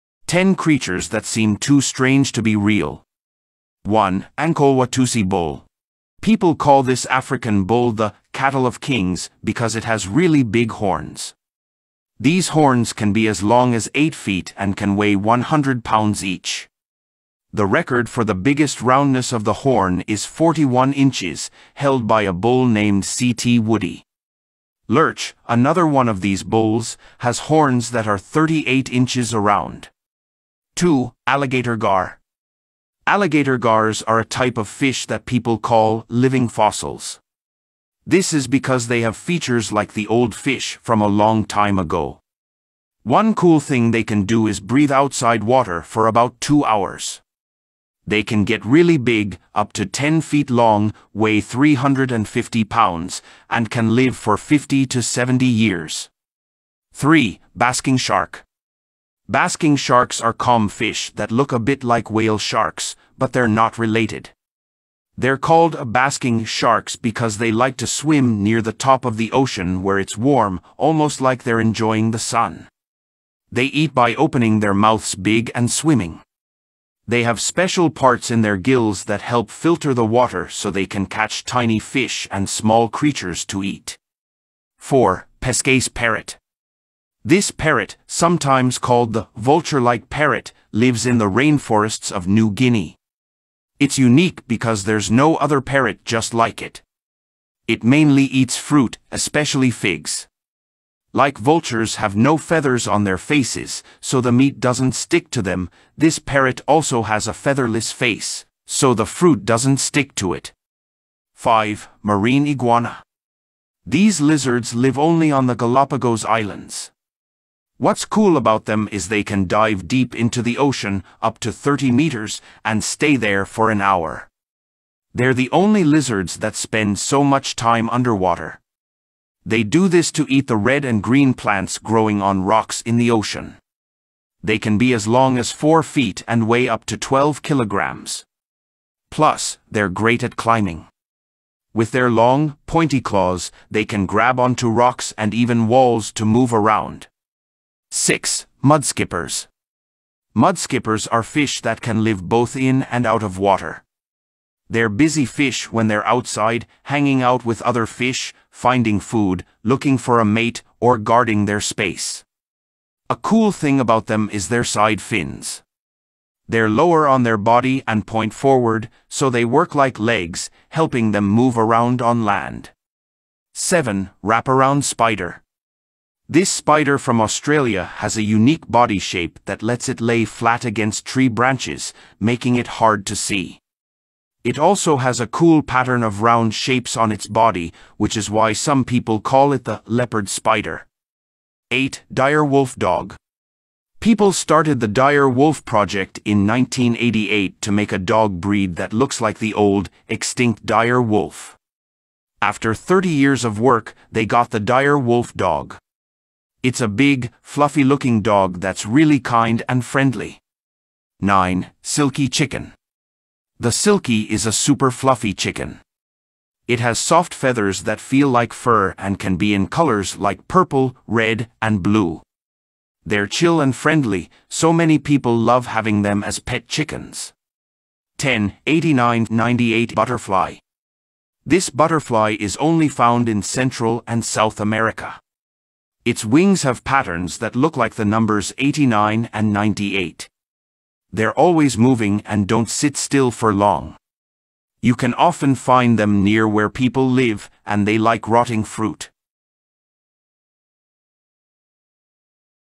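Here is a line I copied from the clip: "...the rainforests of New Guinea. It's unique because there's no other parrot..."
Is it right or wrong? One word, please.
right.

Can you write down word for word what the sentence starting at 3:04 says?
It also has a cool pattern of round shapes on its body, which is why some people call it the leopard spider.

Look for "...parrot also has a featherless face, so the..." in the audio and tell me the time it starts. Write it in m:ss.
1:46.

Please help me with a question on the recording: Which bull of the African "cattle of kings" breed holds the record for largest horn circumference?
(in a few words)
C.T. Woodie.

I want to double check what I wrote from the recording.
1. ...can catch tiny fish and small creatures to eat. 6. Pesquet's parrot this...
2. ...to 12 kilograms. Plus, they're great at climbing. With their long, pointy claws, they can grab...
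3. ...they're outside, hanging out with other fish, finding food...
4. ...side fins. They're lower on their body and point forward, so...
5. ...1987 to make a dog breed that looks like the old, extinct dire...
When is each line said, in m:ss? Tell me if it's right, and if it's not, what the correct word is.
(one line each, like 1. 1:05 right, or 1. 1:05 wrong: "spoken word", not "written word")
1. 1:20 wrong: "4", not "6"
2. 2:16 right
3. 2:35 right
4. 2:44 right
5. 3:16 wrong: "1988", not "1987".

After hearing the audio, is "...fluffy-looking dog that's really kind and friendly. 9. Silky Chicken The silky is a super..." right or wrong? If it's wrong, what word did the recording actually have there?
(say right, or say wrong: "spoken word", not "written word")
right.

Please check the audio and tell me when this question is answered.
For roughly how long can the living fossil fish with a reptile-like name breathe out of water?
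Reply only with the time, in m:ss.
0:46.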